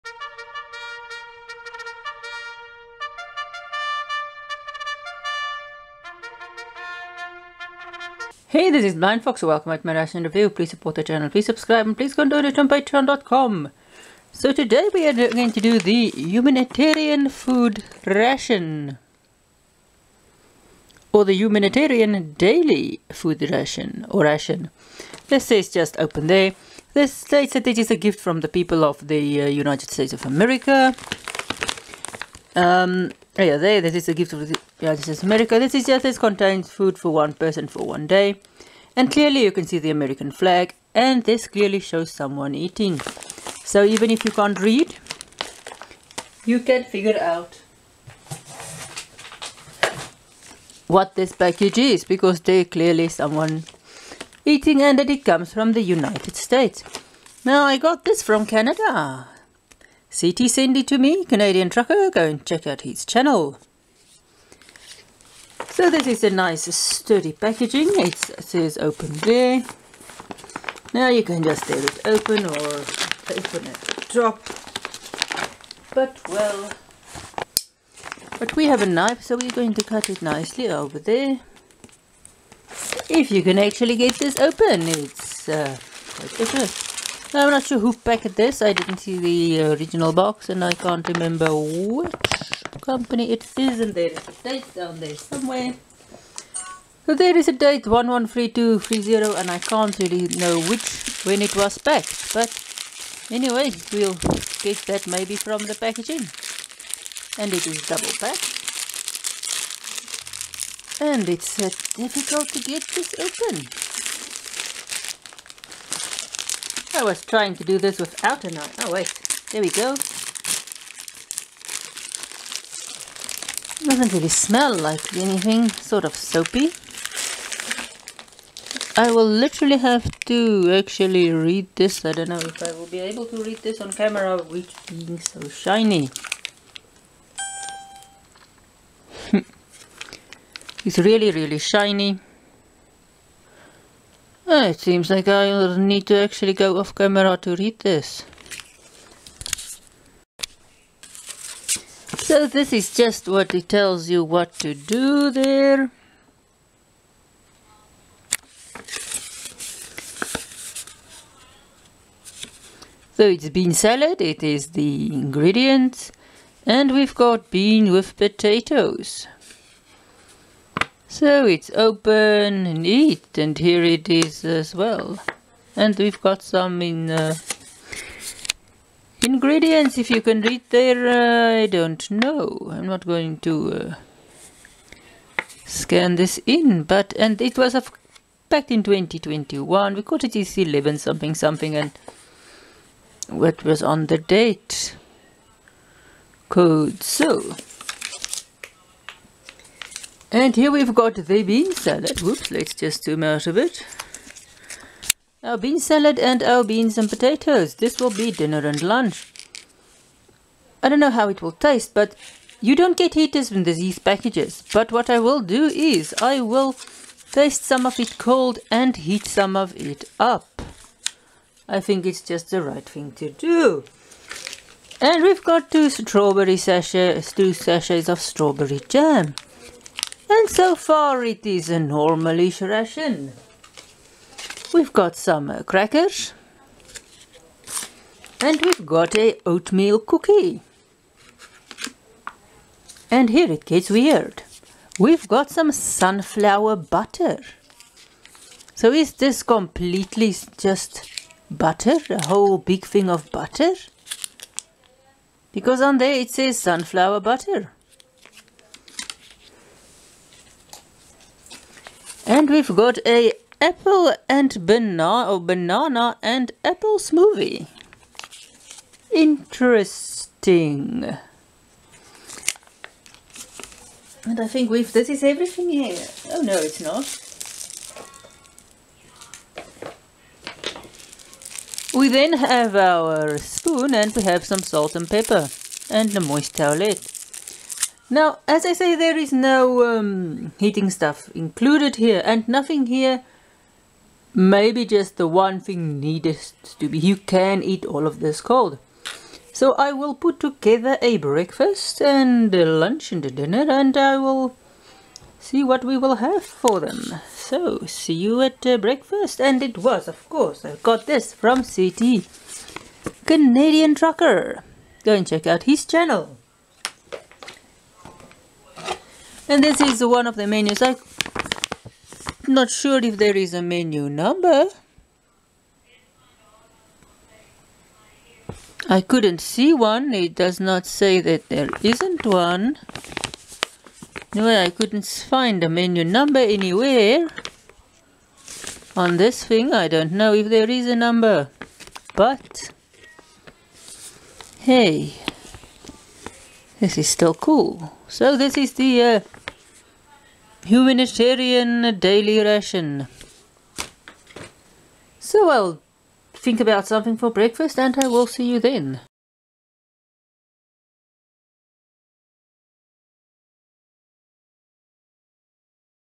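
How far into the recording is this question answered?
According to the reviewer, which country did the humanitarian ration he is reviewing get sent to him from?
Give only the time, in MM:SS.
00:58.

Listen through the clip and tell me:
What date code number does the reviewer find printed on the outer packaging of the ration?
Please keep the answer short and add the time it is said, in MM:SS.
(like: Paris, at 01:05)
113230, at 01:37.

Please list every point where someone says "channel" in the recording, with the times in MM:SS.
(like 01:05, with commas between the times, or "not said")
00:11, 01:03, 05:15.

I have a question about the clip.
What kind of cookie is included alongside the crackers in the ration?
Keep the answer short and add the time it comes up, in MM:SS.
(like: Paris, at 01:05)
Oatmeal, at 03:59.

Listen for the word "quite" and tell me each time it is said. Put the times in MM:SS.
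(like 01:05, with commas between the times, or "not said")
01:26.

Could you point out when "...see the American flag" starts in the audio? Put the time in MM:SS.
00:39.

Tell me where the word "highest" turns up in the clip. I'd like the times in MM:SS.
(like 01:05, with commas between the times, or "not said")
not said.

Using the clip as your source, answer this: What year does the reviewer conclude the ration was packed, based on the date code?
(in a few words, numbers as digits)
2021.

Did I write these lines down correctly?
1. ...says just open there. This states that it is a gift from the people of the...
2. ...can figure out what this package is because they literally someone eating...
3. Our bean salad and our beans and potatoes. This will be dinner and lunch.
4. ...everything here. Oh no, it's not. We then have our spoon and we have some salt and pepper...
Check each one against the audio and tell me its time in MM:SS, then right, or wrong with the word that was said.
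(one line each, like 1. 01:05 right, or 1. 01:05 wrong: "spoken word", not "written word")
1. 00:25 right
2. 00:46 wrong: "clearly", not "literally"
3. 03:25 right
4. 04:35 right.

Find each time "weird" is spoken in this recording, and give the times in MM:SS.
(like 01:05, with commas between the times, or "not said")
04:03.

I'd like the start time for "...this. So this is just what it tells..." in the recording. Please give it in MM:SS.
02:27.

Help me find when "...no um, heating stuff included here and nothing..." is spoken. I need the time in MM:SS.
04:49.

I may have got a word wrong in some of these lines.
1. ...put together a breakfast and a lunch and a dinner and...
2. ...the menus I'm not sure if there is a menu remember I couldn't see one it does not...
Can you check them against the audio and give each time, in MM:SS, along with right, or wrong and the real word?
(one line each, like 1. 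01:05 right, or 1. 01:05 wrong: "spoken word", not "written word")
1. 05:00 right
2. 05:20 wrong: "number", not "remember".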